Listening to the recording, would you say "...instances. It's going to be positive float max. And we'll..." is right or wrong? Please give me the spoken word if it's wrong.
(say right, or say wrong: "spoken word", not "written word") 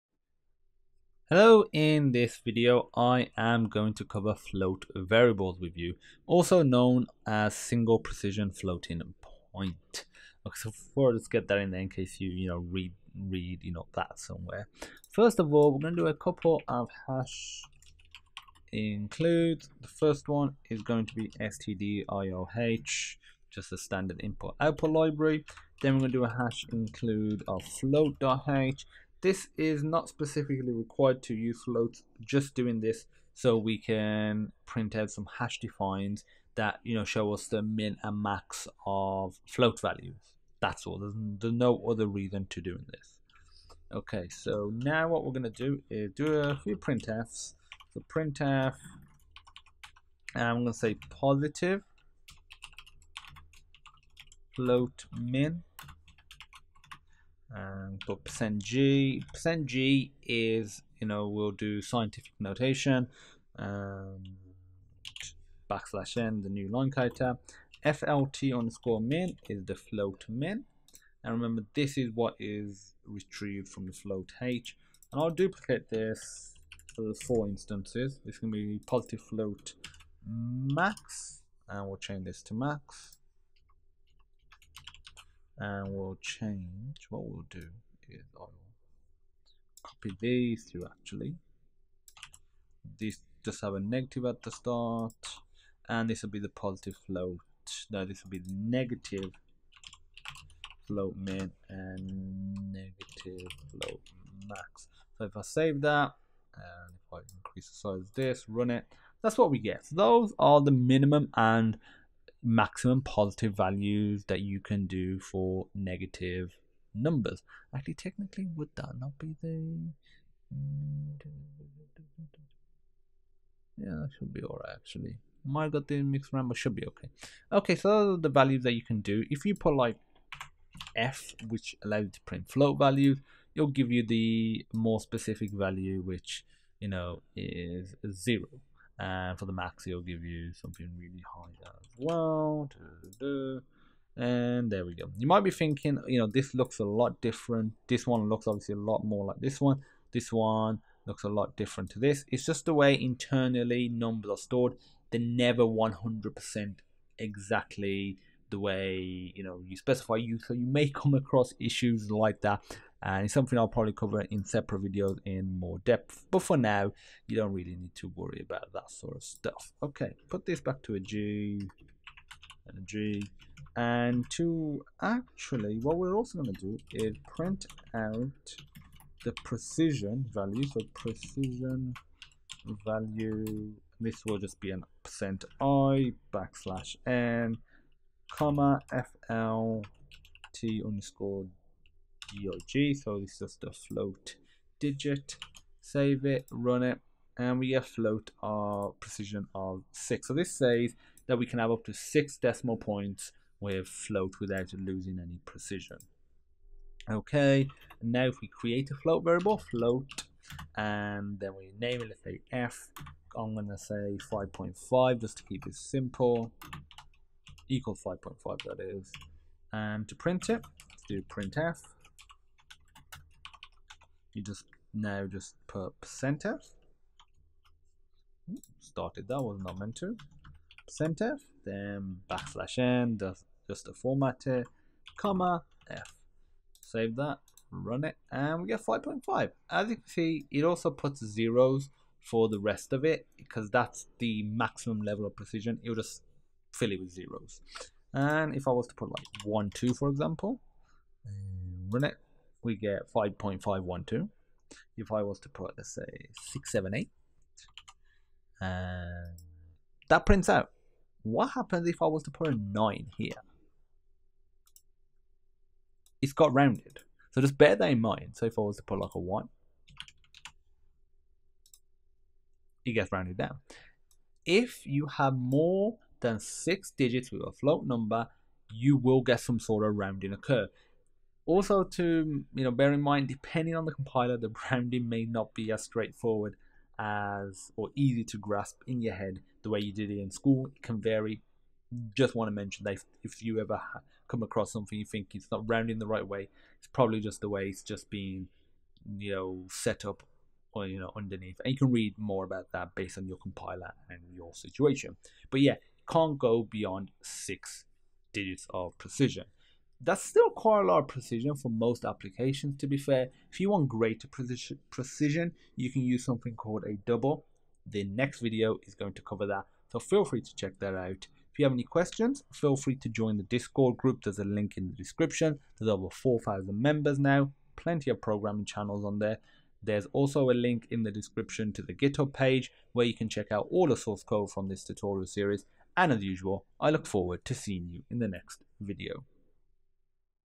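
right.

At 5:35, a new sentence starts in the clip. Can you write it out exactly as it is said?
And as usual, I look forward to seeing you in the next video.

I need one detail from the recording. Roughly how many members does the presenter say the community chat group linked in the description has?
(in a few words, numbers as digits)
over 4,000.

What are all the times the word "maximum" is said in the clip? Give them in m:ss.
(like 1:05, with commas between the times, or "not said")
1:52, 4:04.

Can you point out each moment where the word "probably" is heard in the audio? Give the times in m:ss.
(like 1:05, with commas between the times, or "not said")
2:43, 4:56.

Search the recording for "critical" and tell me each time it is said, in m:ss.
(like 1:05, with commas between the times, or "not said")
not said.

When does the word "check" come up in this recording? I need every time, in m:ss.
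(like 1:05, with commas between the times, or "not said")
5:20, 5:33.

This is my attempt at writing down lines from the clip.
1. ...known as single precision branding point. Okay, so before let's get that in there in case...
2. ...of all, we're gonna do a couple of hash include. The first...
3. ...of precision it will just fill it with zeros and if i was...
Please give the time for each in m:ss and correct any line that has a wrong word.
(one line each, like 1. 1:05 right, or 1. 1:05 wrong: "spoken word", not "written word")
1. 0:06 wrong: "floating", not "branding"
2. 0:15 right
3. 4:05 right.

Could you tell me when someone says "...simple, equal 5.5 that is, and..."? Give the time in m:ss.
3:35.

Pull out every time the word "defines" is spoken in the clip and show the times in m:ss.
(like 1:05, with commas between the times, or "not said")
0:35.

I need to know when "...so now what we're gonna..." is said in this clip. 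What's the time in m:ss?
0:44.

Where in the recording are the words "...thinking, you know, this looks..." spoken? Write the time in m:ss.
2:25.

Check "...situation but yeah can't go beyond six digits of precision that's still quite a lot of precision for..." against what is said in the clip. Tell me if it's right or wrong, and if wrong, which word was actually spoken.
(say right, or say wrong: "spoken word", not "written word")
right.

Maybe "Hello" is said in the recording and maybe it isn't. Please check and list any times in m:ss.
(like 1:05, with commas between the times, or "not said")
0:01.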